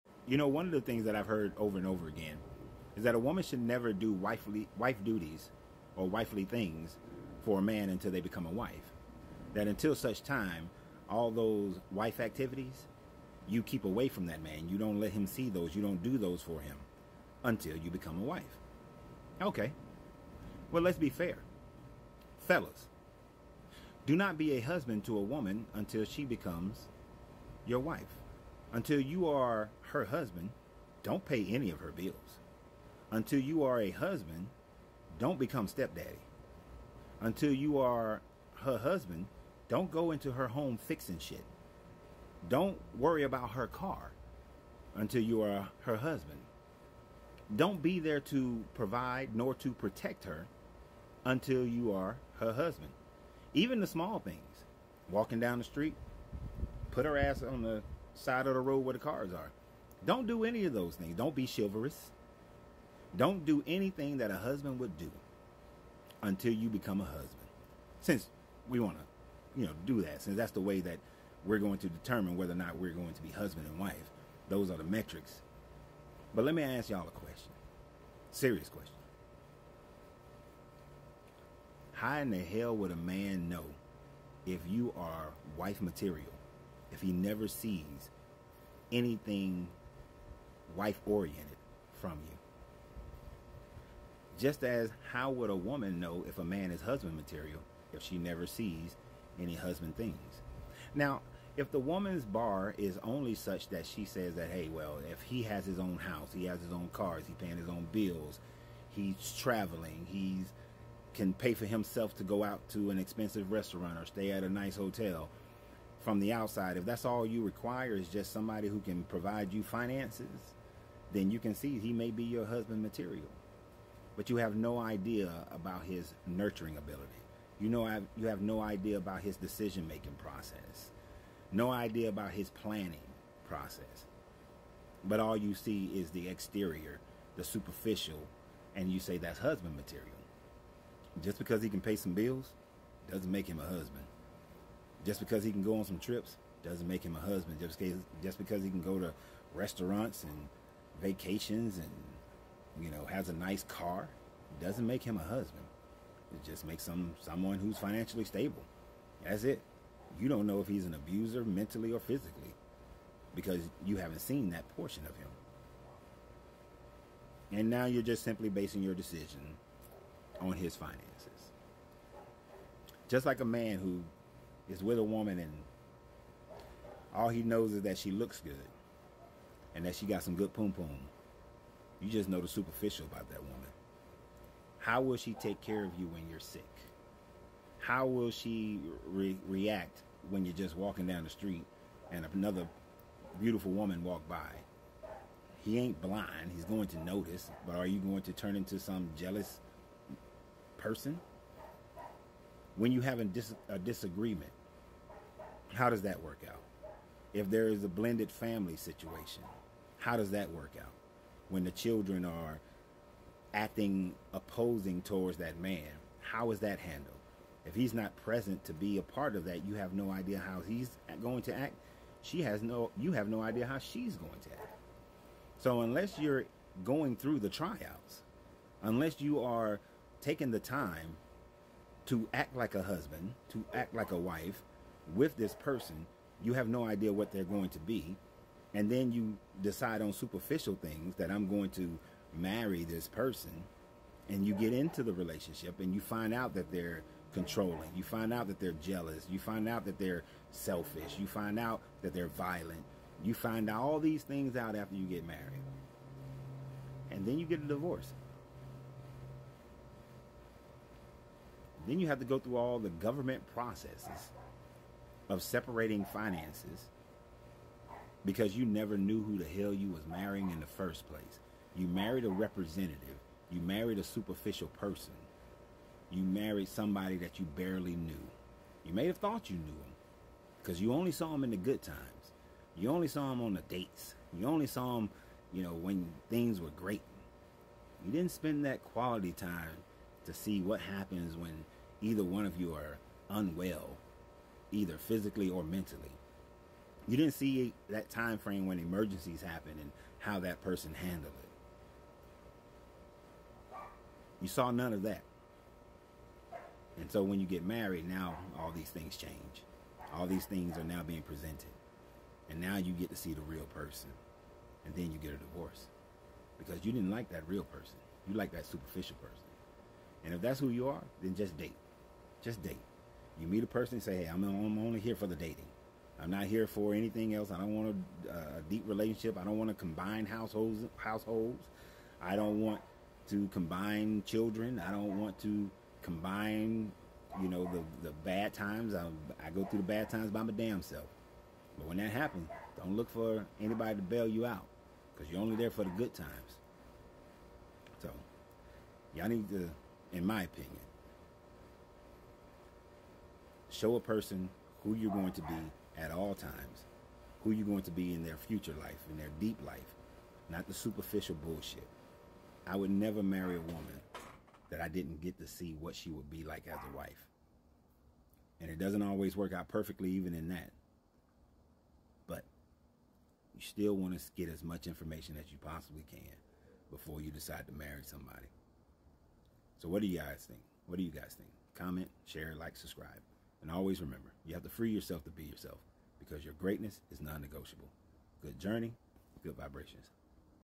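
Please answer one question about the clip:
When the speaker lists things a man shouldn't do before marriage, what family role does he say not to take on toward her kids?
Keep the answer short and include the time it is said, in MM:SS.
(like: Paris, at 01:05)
stepdaddy, at 00:35.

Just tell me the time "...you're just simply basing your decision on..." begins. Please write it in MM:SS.
02:47.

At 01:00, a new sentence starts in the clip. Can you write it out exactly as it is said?
Don't do any of those things.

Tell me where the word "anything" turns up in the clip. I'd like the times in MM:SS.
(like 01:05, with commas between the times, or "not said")
01:03, 01:28, 05:26.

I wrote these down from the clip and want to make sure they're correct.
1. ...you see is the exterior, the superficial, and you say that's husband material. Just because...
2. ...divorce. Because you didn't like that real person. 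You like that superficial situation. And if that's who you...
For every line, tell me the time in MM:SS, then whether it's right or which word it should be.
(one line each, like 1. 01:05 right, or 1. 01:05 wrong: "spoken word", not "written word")
1. 02:15 right
2. 05:15 wrong: "person", not "situation".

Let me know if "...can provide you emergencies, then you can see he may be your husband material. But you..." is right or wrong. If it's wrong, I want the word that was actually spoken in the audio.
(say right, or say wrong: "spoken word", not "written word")
wrong: "finances", not "emergencies".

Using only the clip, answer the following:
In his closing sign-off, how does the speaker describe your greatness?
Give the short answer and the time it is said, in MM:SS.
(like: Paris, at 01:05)
non negotiable, at 06:27.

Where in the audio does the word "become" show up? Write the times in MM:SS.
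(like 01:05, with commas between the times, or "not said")
00:08, 00:17, 00:26, 00:35, 01:06.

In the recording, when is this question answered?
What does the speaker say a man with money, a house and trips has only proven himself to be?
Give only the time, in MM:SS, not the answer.
02:37.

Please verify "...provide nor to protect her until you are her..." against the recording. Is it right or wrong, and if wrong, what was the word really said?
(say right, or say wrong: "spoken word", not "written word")
right.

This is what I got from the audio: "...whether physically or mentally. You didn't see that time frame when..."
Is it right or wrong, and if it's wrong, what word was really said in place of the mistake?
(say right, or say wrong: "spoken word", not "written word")
wrong: "either", not "whether".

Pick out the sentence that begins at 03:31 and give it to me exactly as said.
When the children are acting opposing towards that man, how is that handled?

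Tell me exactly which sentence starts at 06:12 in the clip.
But you still want to get as much information as you possibly can before you decide to marry somebody.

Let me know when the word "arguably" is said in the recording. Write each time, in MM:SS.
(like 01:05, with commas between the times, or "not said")
not said.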